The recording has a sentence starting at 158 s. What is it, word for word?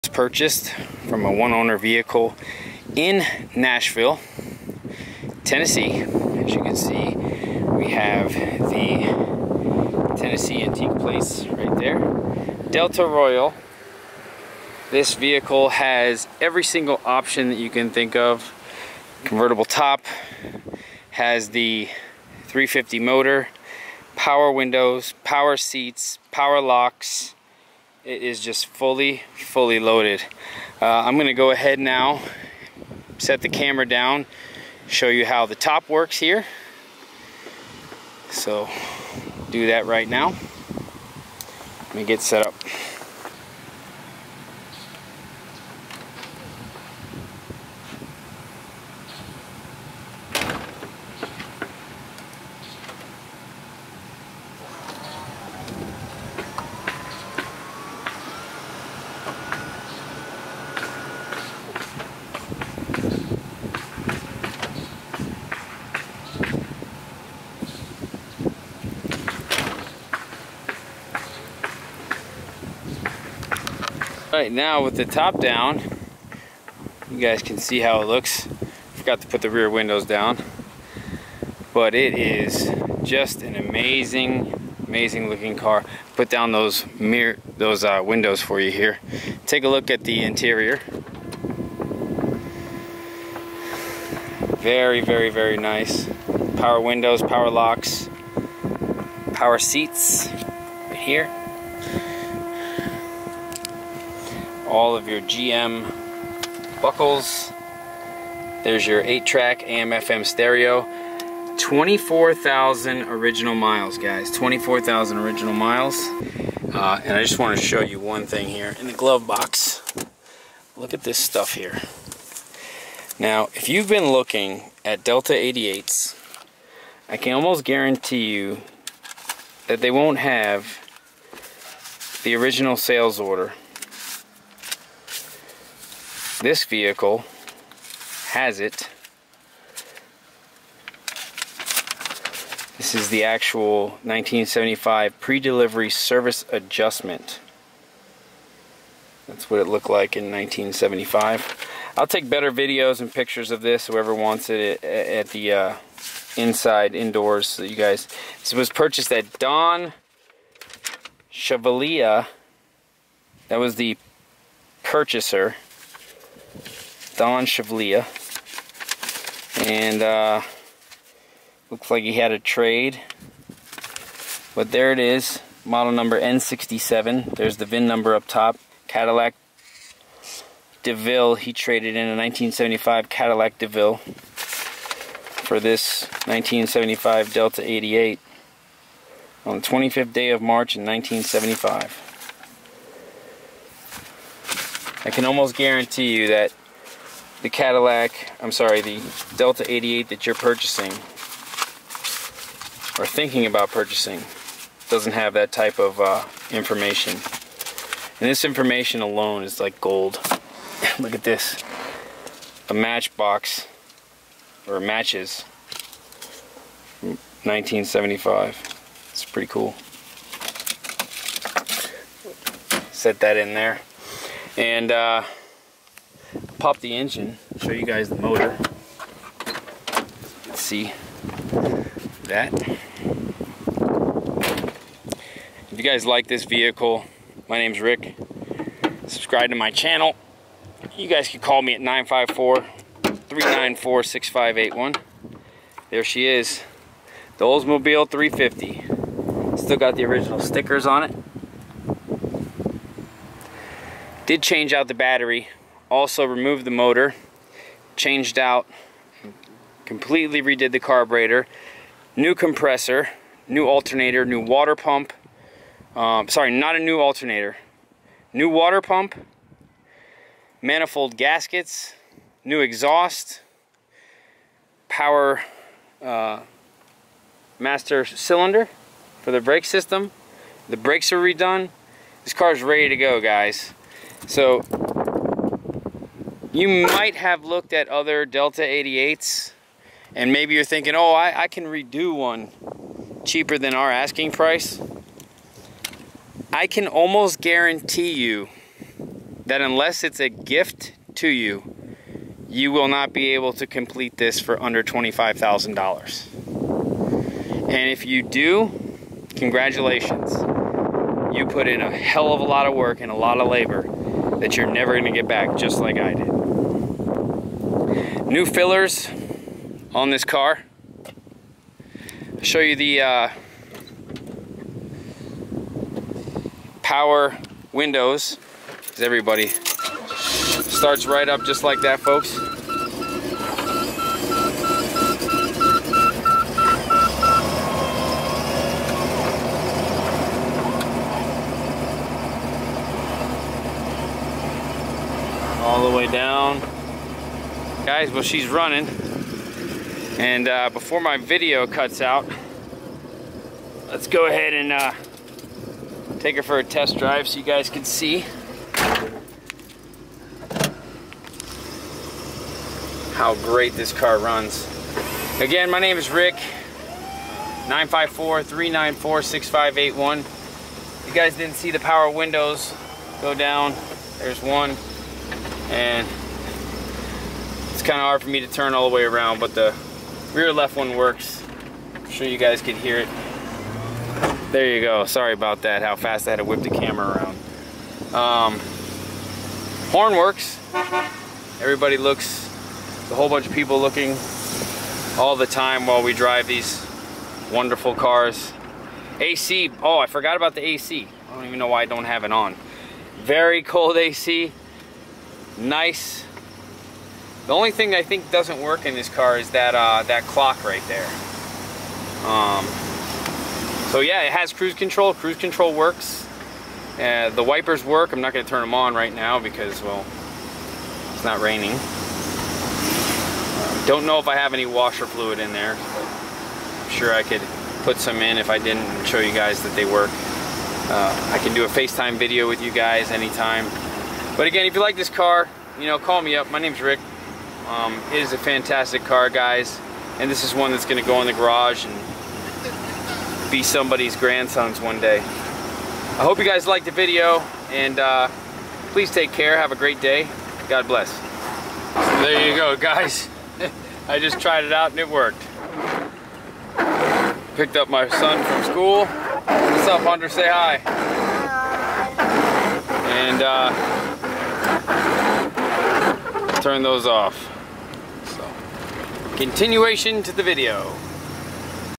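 This was purchased at Don Chevalier.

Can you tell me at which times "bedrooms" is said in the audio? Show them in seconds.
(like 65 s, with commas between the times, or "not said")
not said.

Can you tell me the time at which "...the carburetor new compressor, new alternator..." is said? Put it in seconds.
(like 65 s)
260 s.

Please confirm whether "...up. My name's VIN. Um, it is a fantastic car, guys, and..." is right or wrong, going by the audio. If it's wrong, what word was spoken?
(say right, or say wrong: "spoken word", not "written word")
wrong: "Rick", not "VIN".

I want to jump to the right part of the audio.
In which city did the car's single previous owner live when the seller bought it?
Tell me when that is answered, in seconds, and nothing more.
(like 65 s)
3 s.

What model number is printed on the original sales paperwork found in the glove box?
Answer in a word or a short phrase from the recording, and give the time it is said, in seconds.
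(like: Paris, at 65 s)
N67, at 176 s.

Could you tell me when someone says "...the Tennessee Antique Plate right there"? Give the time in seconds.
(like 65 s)
8 s.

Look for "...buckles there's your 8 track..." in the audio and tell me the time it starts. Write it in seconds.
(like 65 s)
106 s.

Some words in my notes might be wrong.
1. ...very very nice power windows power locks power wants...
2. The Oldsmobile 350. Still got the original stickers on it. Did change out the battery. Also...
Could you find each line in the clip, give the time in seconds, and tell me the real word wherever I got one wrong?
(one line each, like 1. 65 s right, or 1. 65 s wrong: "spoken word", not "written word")
1. 95 s wrong: "seats", not "wants"
2. 247 s right.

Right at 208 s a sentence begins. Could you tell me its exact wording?
And this information alone is like gold.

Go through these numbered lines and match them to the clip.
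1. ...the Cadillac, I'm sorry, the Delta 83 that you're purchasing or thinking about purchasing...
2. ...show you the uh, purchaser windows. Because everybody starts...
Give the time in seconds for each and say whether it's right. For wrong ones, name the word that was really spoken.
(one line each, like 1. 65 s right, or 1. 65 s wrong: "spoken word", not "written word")
1. 197 s wrong: "88", not "83"
2. 322 s wrong: "power", not "purchaser".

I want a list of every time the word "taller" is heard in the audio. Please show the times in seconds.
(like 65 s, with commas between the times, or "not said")
not said.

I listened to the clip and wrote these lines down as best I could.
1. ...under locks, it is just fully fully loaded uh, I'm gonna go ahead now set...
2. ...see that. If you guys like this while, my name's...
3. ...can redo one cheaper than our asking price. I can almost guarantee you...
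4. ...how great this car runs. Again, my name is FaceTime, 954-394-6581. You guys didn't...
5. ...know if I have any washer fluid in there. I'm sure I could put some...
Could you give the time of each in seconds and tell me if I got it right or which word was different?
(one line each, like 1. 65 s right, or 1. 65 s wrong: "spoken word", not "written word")
1. 26 s wrong: "power", not "under"
2. 230 s wrong: "vehicle", not "while"
3. 291 s right
4. 363 s wrong: "Rick", not "FaceTime"
5. 424 s right.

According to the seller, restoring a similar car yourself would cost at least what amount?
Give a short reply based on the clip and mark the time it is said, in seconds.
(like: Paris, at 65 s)
$25,000, at 304 s.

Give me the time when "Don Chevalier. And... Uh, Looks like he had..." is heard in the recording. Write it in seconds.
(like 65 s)
167 s.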